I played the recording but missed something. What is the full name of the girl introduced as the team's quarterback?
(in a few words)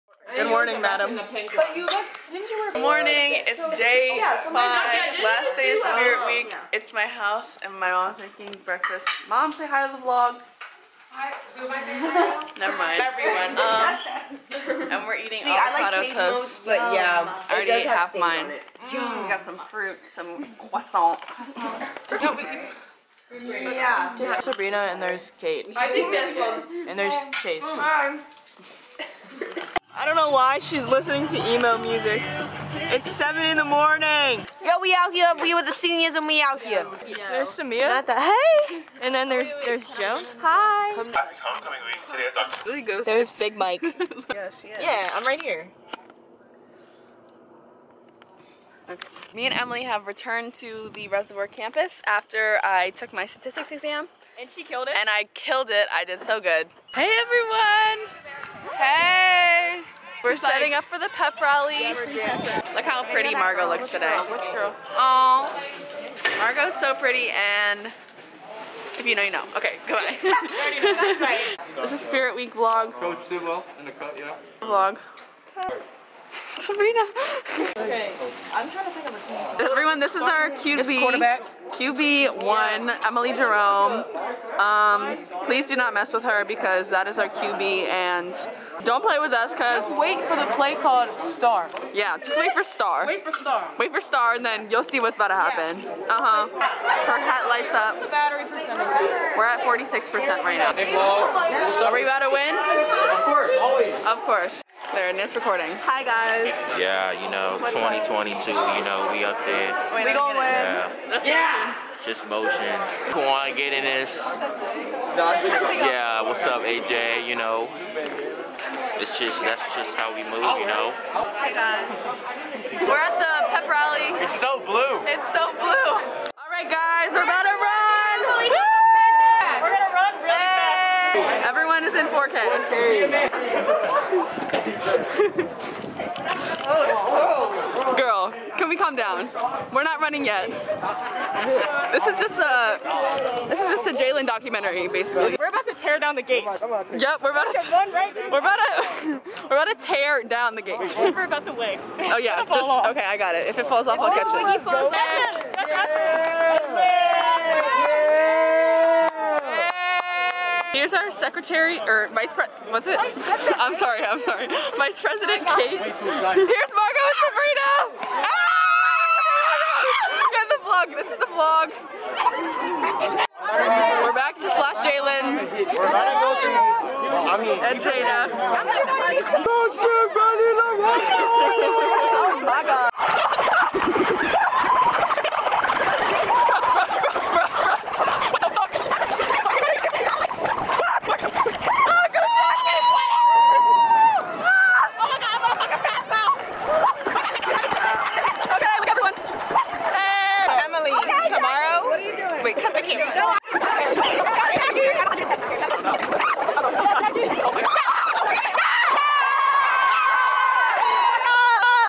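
Emily Jerome.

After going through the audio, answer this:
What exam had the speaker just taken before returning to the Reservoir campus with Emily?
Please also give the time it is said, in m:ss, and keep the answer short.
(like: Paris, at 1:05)
Statistics, at 0:53.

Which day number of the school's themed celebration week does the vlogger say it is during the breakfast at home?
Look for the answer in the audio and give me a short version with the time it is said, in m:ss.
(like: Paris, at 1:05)
5, at 0:03.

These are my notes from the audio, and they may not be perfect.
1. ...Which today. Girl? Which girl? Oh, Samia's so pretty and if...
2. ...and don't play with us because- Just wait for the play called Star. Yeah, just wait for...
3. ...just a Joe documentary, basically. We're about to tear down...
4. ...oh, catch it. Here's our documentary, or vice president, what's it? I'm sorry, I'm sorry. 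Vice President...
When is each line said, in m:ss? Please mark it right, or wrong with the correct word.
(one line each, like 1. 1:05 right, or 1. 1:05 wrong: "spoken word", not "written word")
1. 1:03 wrong: "Margot", not "Samia"
2. 1:27 right
3. 2:23 wrong: "Jalen", not "Joe"
4. 2:34 wrong: "secretary", not "documentary".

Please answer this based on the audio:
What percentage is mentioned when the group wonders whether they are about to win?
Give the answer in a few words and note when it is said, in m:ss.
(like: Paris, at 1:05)
46%, at 1:39.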